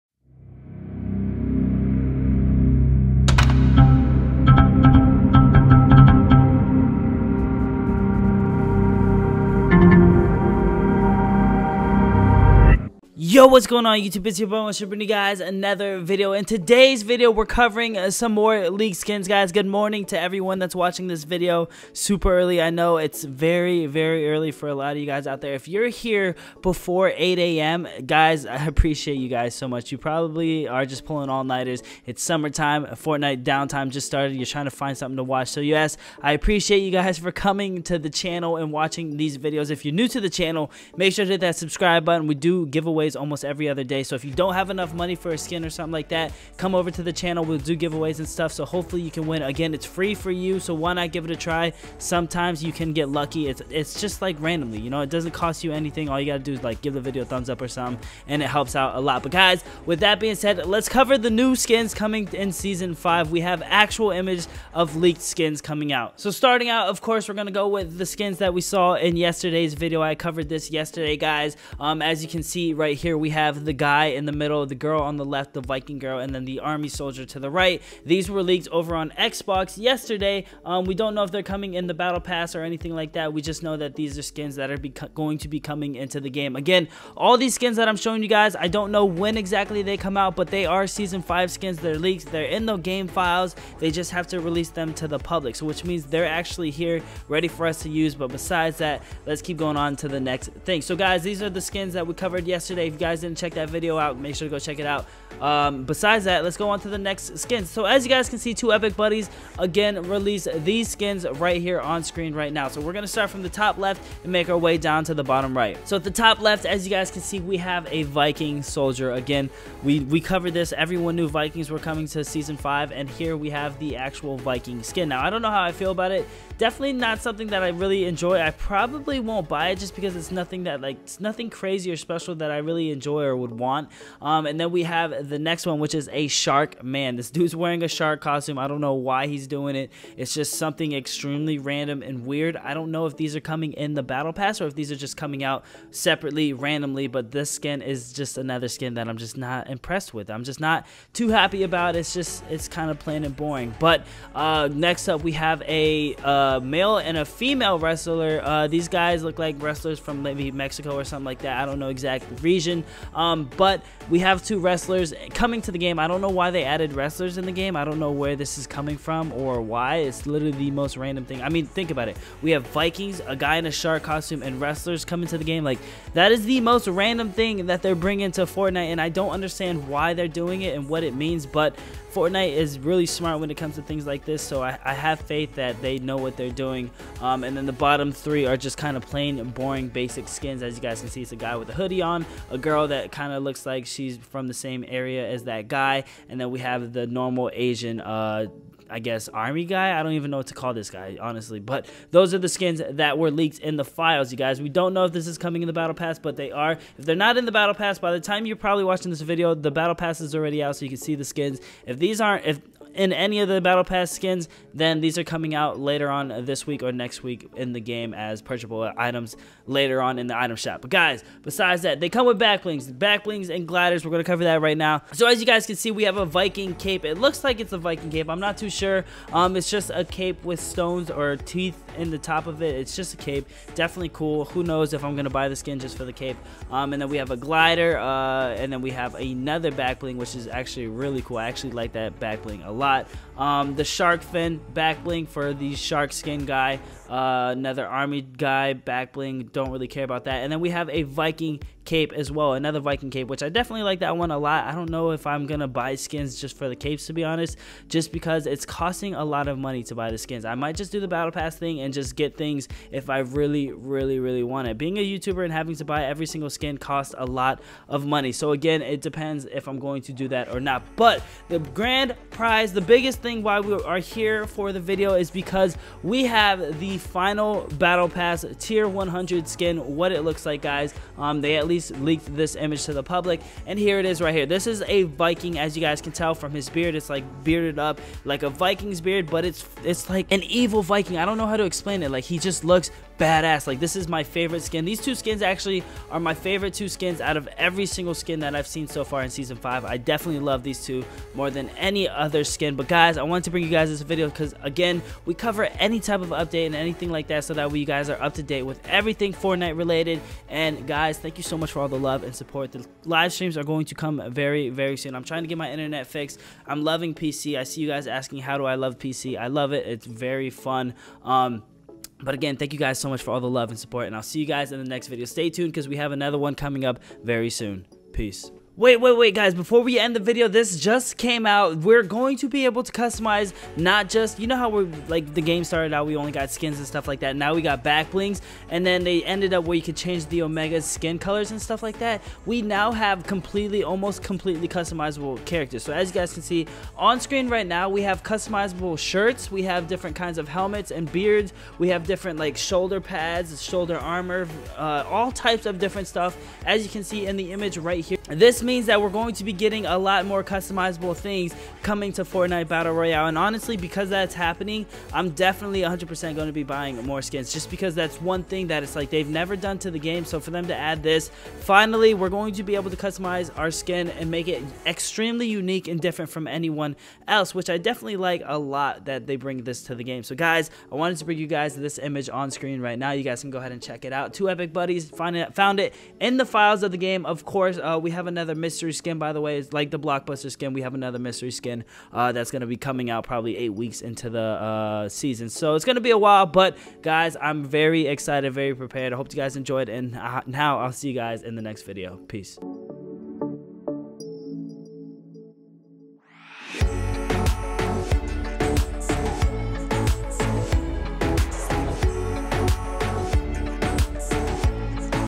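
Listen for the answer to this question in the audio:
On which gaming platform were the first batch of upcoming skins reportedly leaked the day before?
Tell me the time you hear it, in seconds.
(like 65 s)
79 s.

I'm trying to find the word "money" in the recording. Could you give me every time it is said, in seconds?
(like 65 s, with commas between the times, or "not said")
44 s, 259 s, 268 s.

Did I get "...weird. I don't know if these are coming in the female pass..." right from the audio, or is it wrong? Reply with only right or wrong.
wrong.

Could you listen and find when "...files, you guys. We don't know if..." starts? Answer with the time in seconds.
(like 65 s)
203 s.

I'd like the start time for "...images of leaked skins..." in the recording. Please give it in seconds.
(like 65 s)
64 s.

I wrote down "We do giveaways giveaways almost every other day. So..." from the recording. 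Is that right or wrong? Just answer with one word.
right.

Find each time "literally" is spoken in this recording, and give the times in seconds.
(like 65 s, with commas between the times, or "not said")
170 s.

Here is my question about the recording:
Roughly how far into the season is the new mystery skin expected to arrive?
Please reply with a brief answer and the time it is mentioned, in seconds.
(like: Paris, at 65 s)
8 weeks, at 393 s.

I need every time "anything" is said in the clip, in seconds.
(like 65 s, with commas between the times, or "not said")
55 s, 82 s, 306 s.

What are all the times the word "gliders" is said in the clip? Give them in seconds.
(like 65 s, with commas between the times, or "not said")
223 s, 237 s.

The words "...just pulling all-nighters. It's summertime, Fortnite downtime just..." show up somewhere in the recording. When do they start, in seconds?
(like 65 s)
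30 s.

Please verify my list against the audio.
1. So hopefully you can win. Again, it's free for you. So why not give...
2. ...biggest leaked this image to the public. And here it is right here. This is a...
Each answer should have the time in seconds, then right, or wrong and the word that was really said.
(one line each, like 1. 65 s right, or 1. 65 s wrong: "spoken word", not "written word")
1. 48 s right
2. 281 s wrong: "least", not "biggest".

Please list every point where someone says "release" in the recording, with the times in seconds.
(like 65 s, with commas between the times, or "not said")
94 s, 110 s.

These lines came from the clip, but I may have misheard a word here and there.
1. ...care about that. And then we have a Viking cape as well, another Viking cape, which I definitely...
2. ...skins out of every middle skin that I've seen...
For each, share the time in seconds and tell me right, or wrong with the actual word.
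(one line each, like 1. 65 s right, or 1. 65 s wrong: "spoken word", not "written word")
1. 249 s right
2. 296 s wrong: "single", not "middle".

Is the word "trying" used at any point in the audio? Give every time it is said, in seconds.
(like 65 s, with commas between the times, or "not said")
34 s, 315 s.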